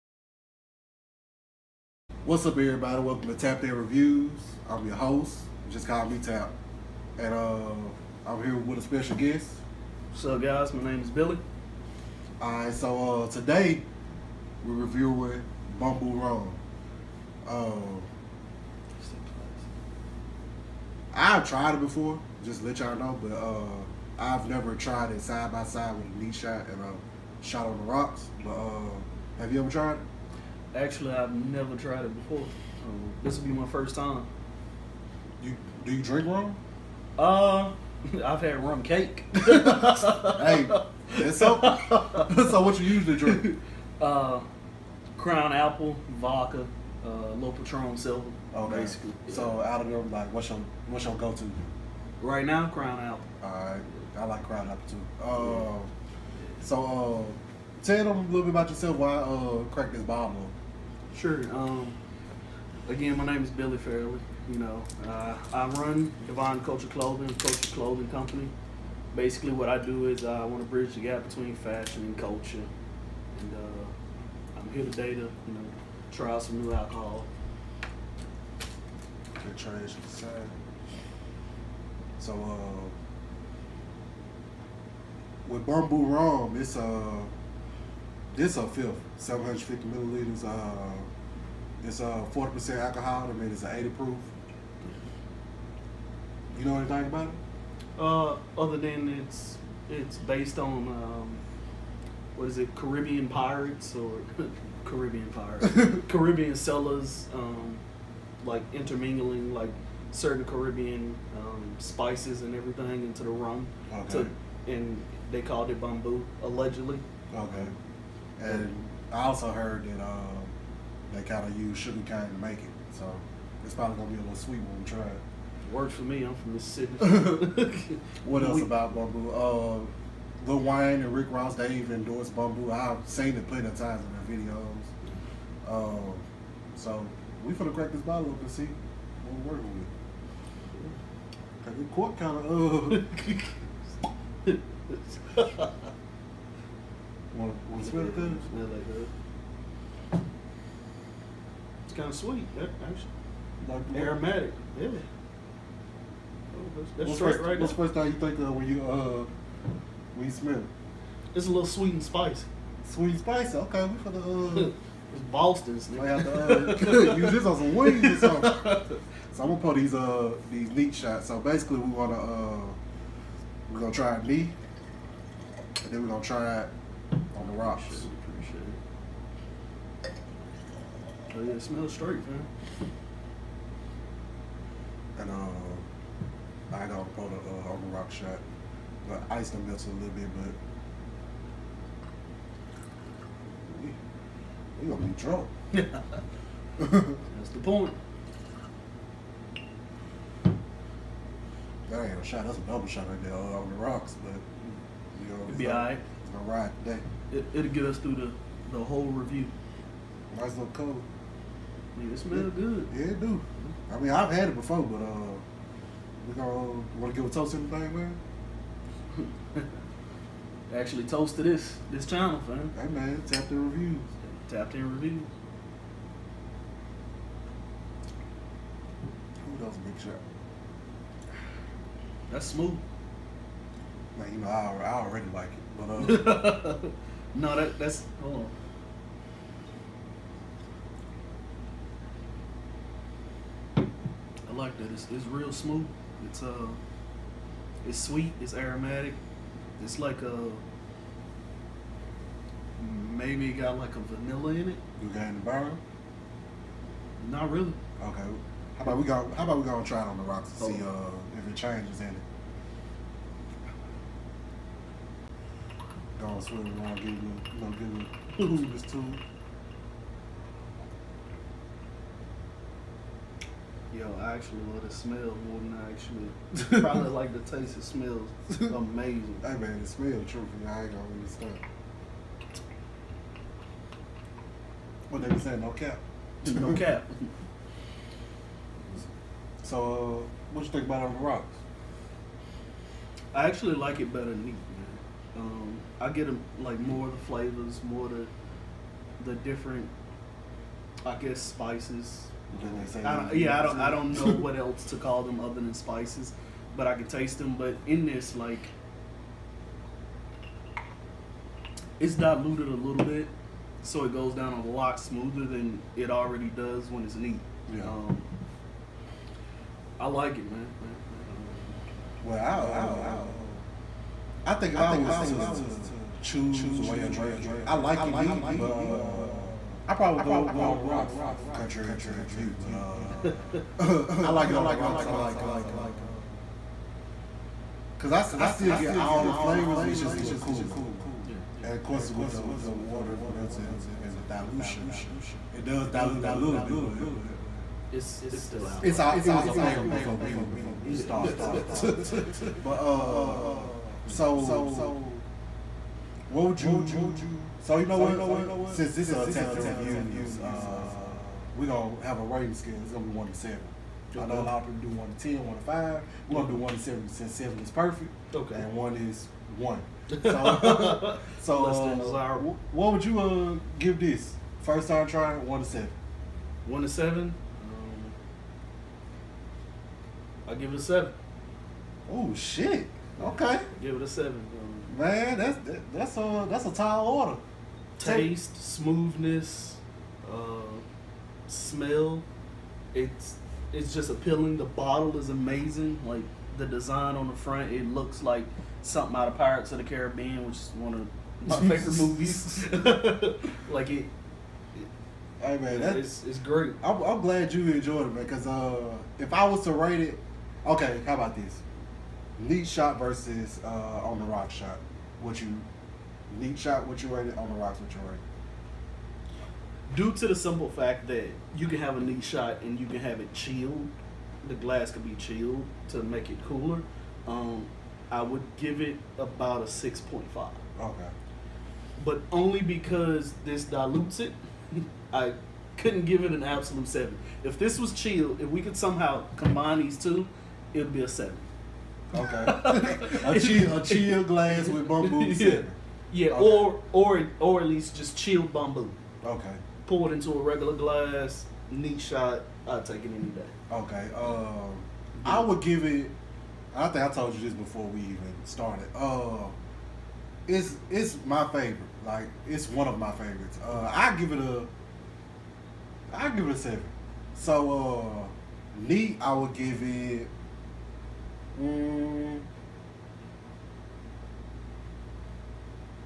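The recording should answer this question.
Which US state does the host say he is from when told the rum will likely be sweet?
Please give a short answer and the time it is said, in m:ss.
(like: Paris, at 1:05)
Mississippi, at 2:06.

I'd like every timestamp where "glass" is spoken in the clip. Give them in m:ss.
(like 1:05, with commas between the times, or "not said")
7:04, 7:24, 7:30.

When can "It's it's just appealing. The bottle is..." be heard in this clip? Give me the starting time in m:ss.
6:32.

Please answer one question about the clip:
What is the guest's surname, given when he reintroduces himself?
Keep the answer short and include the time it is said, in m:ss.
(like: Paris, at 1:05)
Fairley, at 1:03.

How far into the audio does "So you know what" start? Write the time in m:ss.
5:57.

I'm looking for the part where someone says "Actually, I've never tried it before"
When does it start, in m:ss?
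0:30.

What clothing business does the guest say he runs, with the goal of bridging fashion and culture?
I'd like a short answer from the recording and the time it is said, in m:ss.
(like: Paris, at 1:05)
Divine Culture Clothing, at 1:06.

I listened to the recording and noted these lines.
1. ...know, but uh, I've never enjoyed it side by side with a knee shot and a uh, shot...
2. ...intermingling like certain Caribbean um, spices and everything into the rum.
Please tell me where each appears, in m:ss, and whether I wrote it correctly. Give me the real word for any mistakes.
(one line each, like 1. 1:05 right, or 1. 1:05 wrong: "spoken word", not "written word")
1. 0:22 wrong: "tried", not "enjoyed"
2. 1:48 right.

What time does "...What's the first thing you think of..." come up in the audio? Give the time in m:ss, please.
2:37.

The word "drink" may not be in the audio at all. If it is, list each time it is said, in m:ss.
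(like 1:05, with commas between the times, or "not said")
0:36, 0:43, 5:27.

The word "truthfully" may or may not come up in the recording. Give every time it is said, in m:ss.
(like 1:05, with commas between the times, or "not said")
4:40.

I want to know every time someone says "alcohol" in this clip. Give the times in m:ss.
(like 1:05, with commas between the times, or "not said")
1:16, 1:32.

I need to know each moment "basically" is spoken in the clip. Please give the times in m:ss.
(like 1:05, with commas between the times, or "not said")
0:48, 1:09, 2:51.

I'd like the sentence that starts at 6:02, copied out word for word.
It's gonna be one to seven.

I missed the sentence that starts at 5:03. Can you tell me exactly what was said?
I don't, yeah, I don't I don't know what else to call them other than spices, but I can taste them.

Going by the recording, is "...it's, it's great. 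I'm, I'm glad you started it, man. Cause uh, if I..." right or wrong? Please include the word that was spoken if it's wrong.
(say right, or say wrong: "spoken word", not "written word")
wrong: "enjoyed", not "started".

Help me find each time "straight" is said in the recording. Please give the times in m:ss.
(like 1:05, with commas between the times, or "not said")
2:37, 3:01.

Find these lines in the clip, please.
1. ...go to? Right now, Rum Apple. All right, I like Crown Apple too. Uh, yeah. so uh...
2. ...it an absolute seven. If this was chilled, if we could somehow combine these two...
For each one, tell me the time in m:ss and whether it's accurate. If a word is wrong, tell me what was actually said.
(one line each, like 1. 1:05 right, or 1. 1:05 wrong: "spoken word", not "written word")
1. 0:51 wrong: "Crown", not "Rum"
2. 7:16 right.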